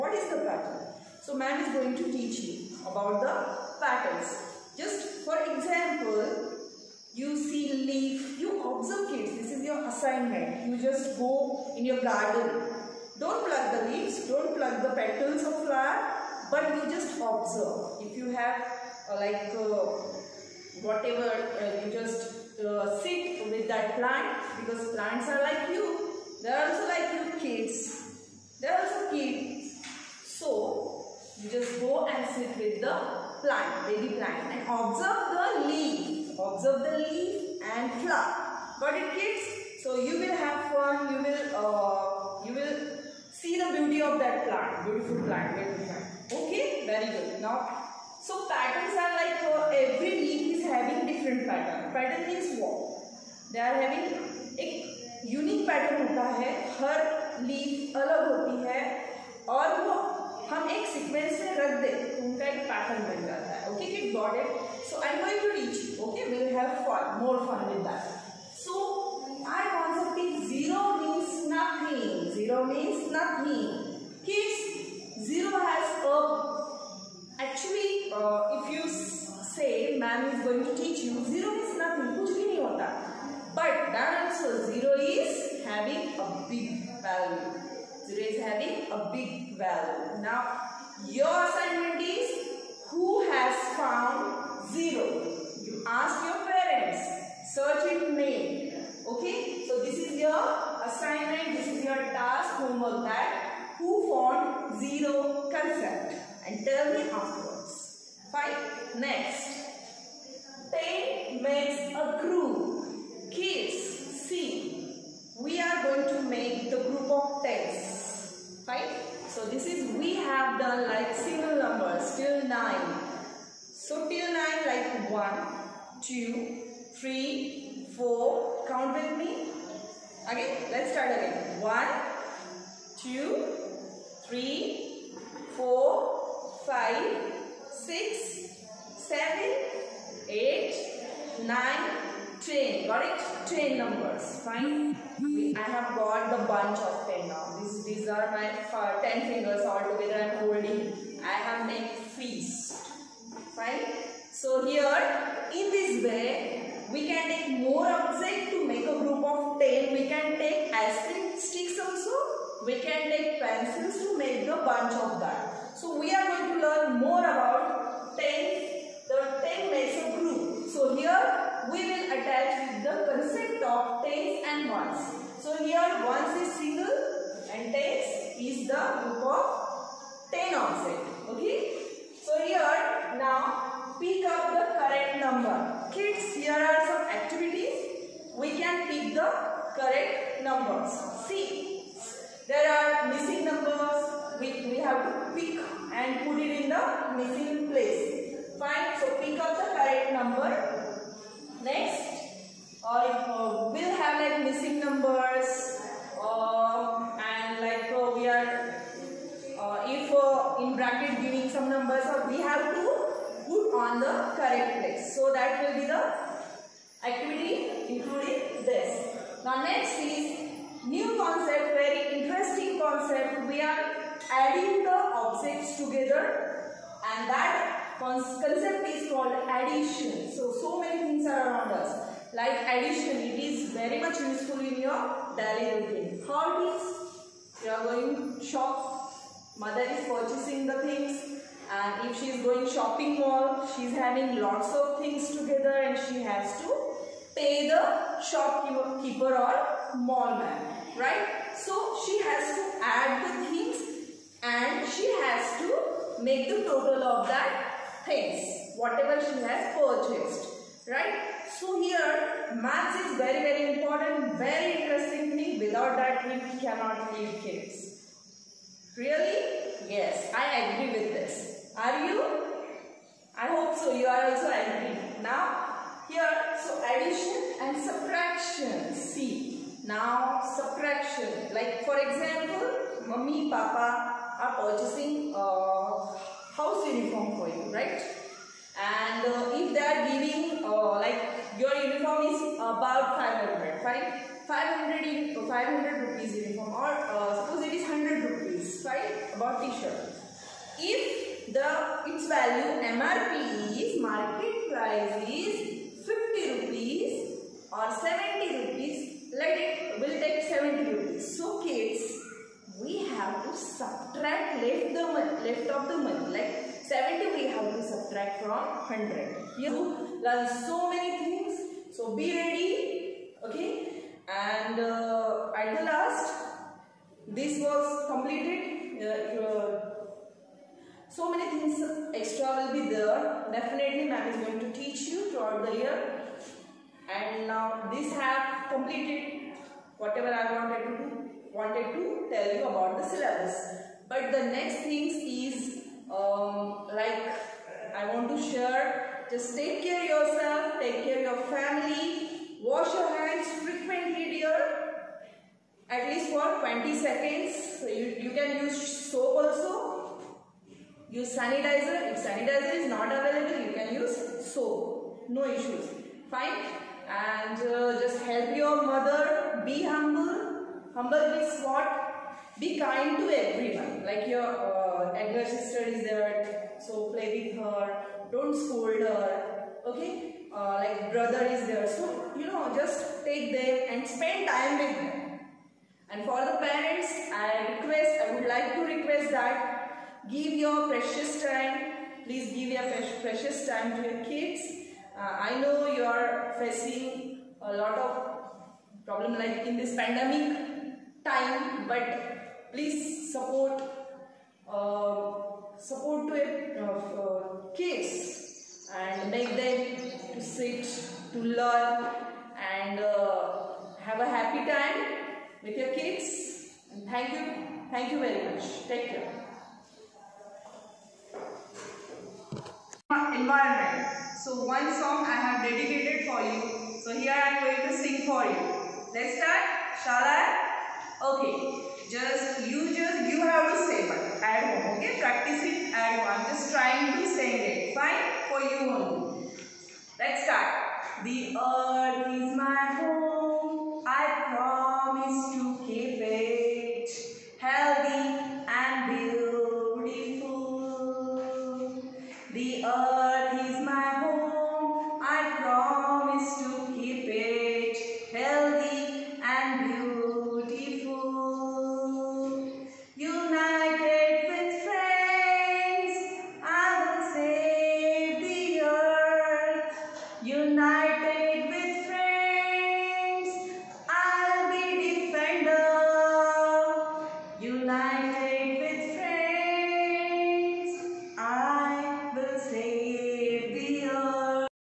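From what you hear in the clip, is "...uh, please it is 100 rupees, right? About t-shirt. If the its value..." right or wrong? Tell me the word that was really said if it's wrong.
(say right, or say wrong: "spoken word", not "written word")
wrong: "suppose", not "please".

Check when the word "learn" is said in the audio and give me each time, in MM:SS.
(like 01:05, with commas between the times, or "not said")
02:46, 05:20, 06:51.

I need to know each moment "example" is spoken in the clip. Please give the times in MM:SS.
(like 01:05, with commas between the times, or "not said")
00:05, 04:41.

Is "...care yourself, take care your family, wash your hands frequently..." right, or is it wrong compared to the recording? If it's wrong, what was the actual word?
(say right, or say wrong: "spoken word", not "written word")
right.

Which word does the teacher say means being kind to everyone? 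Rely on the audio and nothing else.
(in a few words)
humble.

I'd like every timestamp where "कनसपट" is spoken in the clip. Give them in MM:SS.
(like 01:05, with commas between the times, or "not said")
01:09.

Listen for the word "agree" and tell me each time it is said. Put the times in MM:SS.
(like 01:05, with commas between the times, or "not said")
04:30.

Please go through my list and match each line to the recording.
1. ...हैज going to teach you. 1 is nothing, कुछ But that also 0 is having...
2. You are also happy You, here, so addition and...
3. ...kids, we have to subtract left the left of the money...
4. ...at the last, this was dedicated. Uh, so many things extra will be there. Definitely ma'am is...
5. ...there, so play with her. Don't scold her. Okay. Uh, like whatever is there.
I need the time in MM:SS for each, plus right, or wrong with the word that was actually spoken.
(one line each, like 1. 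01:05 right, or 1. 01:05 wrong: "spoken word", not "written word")
1. 01:15 wrong: "0", not "1"
2. 04:33 wrong: "Now", not "You"
3. 05:11 right
4. 05:25 wrong: "completed", not "dedicated"
5. 06:16 wrong: "brother", not "whatever".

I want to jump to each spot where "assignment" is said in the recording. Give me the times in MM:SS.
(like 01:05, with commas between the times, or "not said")
00:09, 01:31, 01:40.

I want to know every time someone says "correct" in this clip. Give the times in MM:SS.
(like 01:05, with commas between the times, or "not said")
02:22, 03:34.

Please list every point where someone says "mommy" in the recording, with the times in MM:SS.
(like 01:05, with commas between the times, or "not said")
04:43.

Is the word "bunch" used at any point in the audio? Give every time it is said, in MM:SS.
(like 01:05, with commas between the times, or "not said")
02:26, 02:44.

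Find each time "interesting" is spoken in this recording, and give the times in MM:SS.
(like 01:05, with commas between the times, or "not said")
03:42, 04:24.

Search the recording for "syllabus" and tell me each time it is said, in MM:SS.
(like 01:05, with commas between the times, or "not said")
05:43.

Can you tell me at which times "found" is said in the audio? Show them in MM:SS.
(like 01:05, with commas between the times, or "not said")
01:33, 01:44.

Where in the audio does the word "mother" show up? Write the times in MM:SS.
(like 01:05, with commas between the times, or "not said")
03:59, 06:08.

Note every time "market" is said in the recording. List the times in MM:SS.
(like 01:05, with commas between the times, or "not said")
05:04.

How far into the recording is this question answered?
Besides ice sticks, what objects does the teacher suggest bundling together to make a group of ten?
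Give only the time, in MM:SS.
02:42.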